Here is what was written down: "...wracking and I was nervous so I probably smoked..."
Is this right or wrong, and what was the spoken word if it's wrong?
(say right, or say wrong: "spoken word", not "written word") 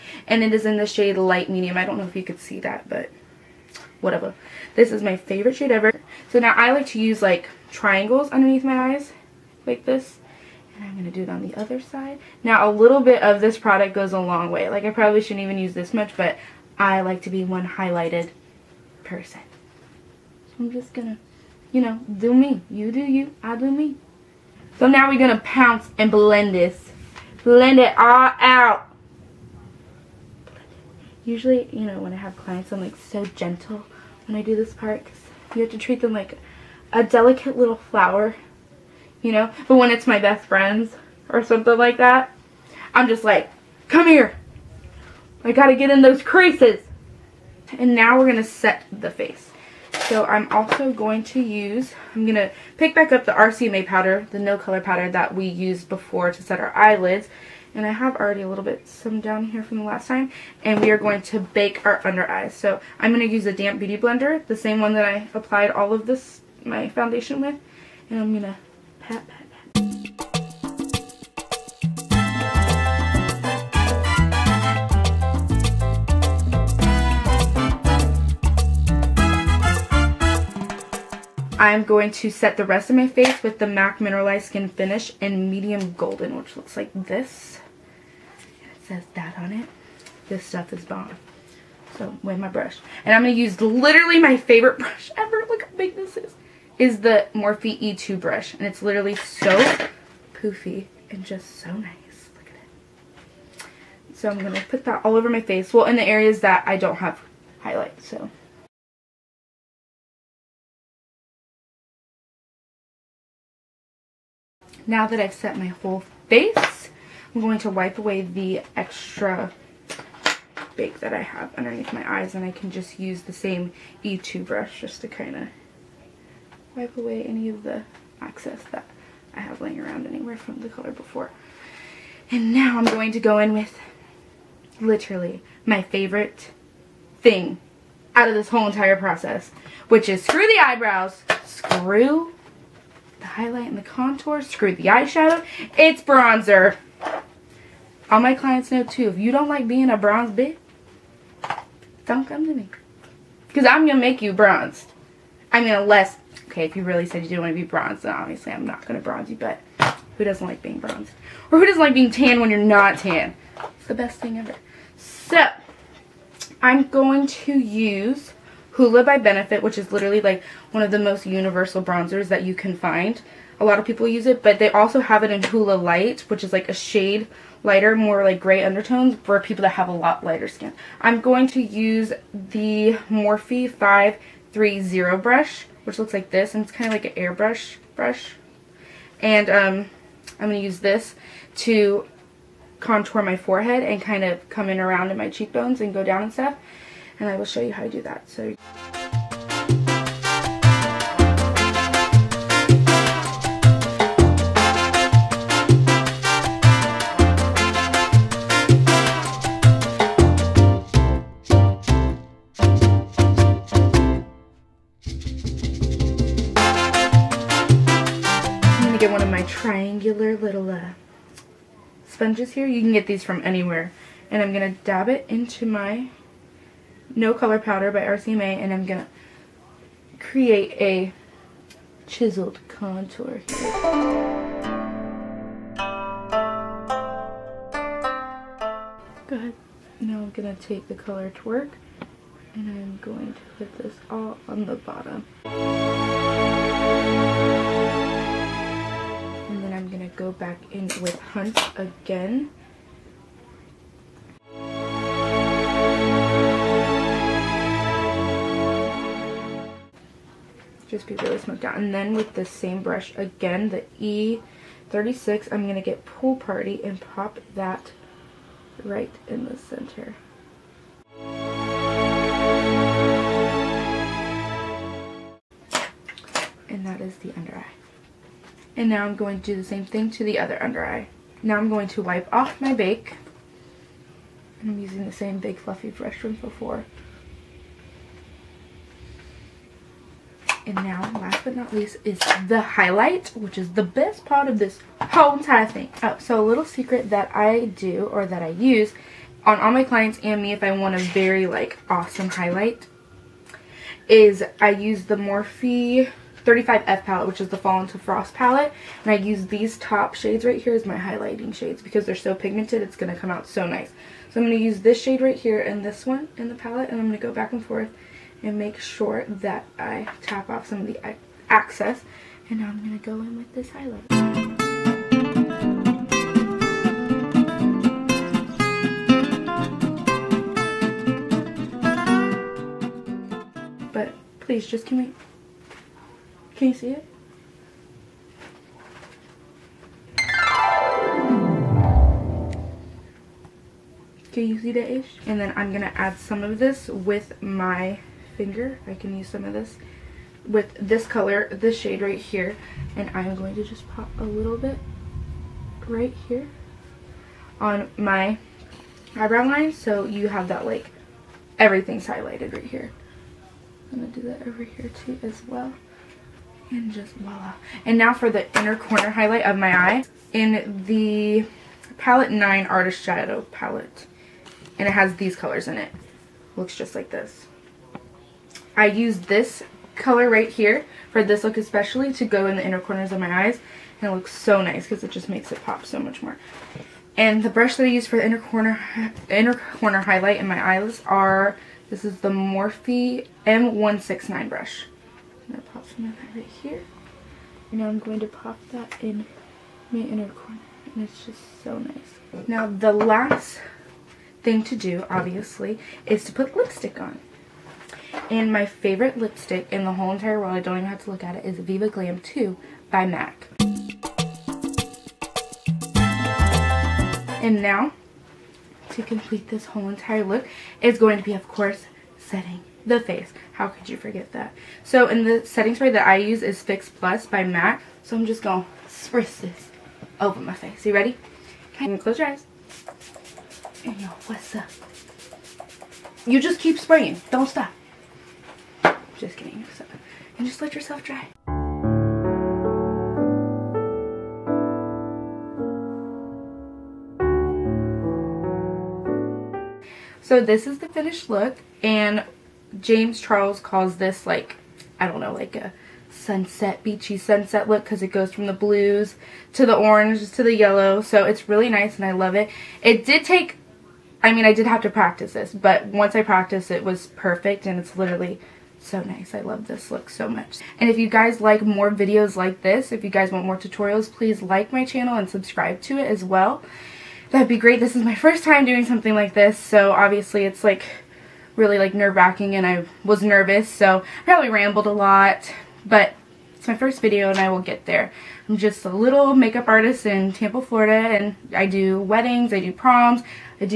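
wrong: "rambled", not "smoked".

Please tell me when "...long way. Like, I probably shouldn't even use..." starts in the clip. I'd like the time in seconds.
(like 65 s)
14 s.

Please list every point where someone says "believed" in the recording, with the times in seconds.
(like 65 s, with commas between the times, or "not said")
not said.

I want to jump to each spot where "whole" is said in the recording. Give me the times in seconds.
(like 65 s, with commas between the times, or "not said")
115 s, 138 s, 295 s, 409 s, 419 s.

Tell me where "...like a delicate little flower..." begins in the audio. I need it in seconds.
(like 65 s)
36 s.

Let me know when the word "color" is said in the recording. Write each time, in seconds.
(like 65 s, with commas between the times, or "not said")
54 s, 130 s, 227 s, 240 s, 351 s, 375 s, 379 s.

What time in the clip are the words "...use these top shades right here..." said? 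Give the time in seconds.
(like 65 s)
309 s.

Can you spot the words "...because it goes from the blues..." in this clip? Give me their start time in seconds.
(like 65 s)
457 s.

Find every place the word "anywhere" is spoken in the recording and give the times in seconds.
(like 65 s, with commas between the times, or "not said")
130 s, 223 s.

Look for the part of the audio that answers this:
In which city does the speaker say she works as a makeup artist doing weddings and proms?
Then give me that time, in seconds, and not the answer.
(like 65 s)
490 s.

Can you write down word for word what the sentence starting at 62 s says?
So I'm gonna use a damp beauty blender, the same one that I applied all of this, my foundation with.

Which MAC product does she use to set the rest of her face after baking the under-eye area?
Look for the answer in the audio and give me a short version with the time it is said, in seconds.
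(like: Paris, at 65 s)
Mineralized Skin Finish, at 83 s.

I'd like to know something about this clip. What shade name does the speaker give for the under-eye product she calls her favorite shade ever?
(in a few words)
Light Medium.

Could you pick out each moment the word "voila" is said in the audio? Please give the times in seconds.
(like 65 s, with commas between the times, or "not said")
367 s.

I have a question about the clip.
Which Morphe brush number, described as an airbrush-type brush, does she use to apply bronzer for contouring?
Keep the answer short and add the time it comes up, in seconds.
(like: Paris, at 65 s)
530, at 183 s.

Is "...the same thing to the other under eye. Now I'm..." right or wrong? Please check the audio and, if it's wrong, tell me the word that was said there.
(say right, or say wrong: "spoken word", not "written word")
right.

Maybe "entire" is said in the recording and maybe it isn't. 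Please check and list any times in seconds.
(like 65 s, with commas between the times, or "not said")
138 s, 295 s, 410 s, 419 s.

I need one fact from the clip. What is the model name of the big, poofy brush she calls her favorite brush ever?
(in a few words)
Morphe E2.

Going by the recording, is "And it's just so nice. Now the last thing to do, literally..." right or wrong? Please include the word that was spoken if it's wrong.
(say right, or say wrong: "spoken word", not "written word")
wrong: "obviously", not "literally".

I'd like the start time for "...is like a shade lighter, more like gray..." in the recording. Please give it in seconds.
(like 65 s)
176 s.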